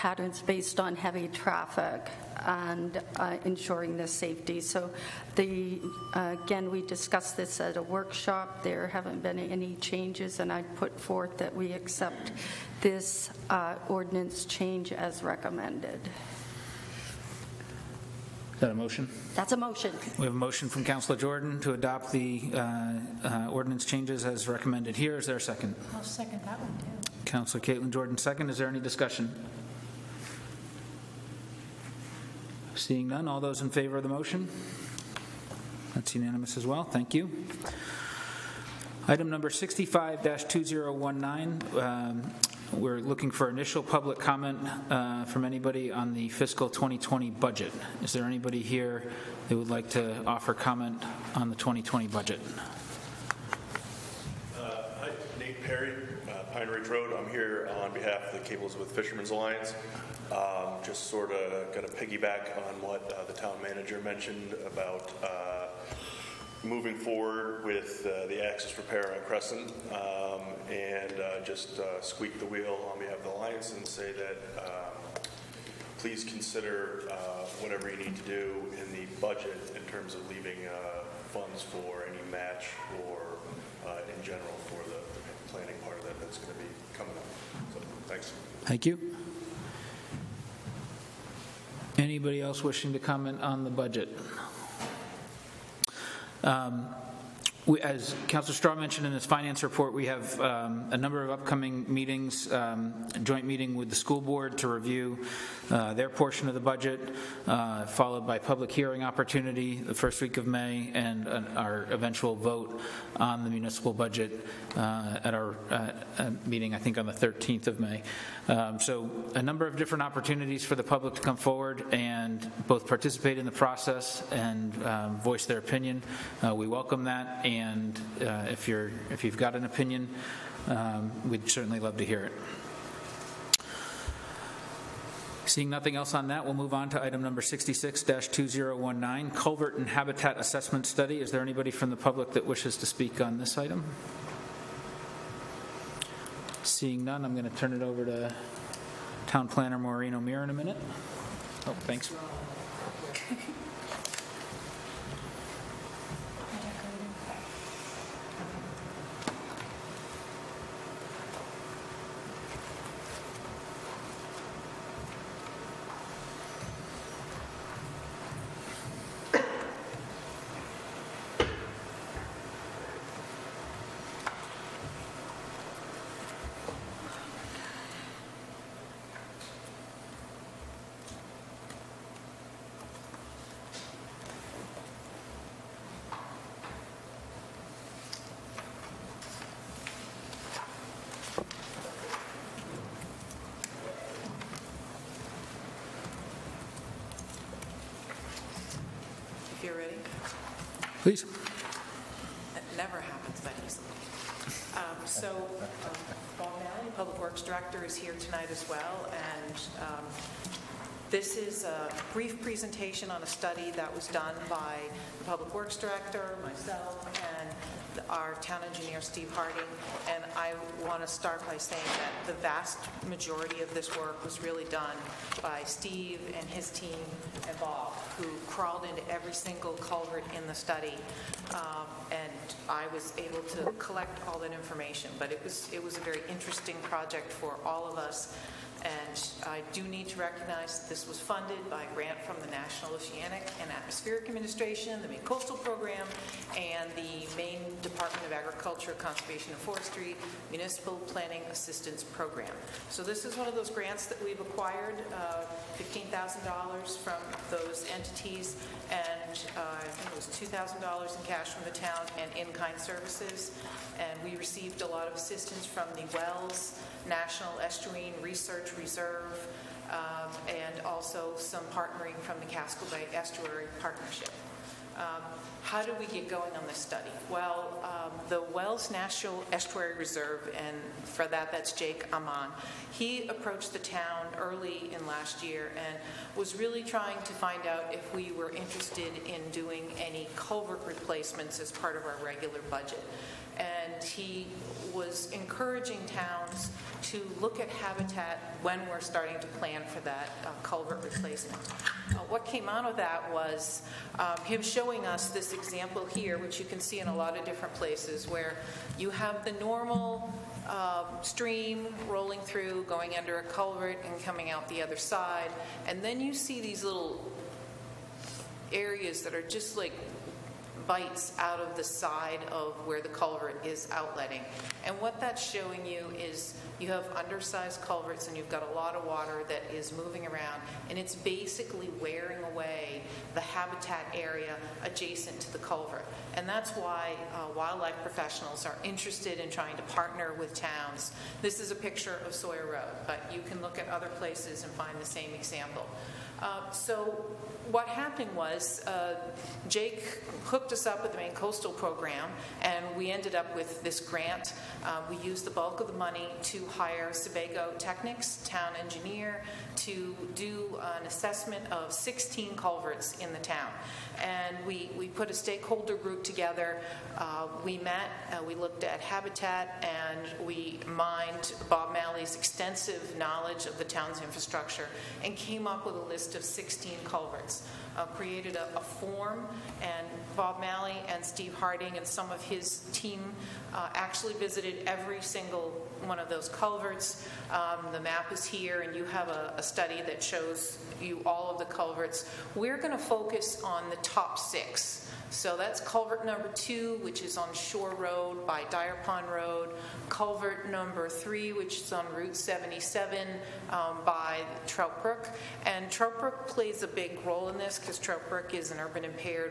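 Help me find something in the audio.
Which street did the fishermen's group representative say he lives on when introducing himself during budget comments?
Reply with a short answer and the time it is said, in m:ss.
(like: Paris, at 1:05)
Pine Ridge Road, at 0:56.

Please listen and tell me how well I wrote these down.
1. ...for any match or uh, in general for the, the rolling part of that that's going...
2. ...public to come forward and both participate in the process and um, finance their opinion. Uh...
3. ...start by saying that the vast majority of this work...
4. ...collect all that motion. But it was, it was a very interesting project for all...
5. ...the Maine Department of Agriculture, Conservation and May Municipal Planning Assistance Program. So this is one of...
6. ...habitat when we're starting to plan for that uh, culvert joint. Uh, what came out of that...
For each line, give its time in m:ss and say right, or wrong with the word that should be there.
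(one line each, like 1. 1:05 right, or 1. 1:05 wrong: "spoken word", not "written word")
1. 1:21 wrong: "planning", not "rolling"
2. 2:00 wrong: "voice", not "finance"
3. 3:41 right
4. 3:53 wrong: "information", not "motion"
5. 4:06 wrong: "Forestry", not "May"
6. 4:57 wrong: "replacement", not "joint".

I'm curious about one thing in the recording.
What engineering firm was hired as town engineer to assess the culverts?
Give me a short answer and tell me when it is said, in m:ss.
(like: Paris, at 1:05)
Sebago Technics, at 5:57.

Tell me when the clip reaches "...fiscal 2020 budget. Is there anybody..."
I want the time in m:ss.
0:46.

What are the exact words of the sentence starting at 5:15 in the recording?
And then you see these little areas that are just like bites out of the side of where the culvert is outletting.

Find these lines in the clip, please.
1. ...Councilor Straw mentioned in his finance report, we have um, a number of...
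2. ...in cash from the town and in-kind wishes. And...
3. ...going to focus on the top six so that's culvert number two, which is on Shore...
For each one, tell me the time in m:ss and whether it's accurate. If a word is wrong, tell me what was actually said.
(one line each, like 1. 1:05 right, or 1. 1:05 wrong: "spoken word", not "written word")
1. 1:38 right
2. 4:21 wrong: "services", not "wishes"
3. 6:32 right.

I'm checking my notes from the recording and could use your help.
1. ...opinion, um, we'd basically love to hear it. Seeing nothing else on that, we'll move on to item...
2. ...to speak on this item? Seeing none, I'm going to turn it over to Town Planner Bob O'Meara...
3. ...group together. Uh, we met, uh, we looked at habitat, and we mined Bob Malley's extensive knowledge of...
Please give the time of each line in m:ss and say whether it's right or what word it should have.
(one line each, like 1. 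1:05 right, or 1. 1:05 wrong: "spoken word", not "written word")
1. 2:09 wrong: "certainly", not "basically"
2. 2:22 wrong: "Maureen", not "Bob"
3. 6:05 right.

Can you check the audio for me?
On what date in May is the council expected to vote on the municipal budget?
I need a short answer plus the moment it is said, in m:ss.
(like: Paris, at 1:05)
May 13, at 1:57.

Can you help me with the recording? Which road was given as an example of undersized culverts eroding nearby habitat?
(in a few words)
Sawyer Road.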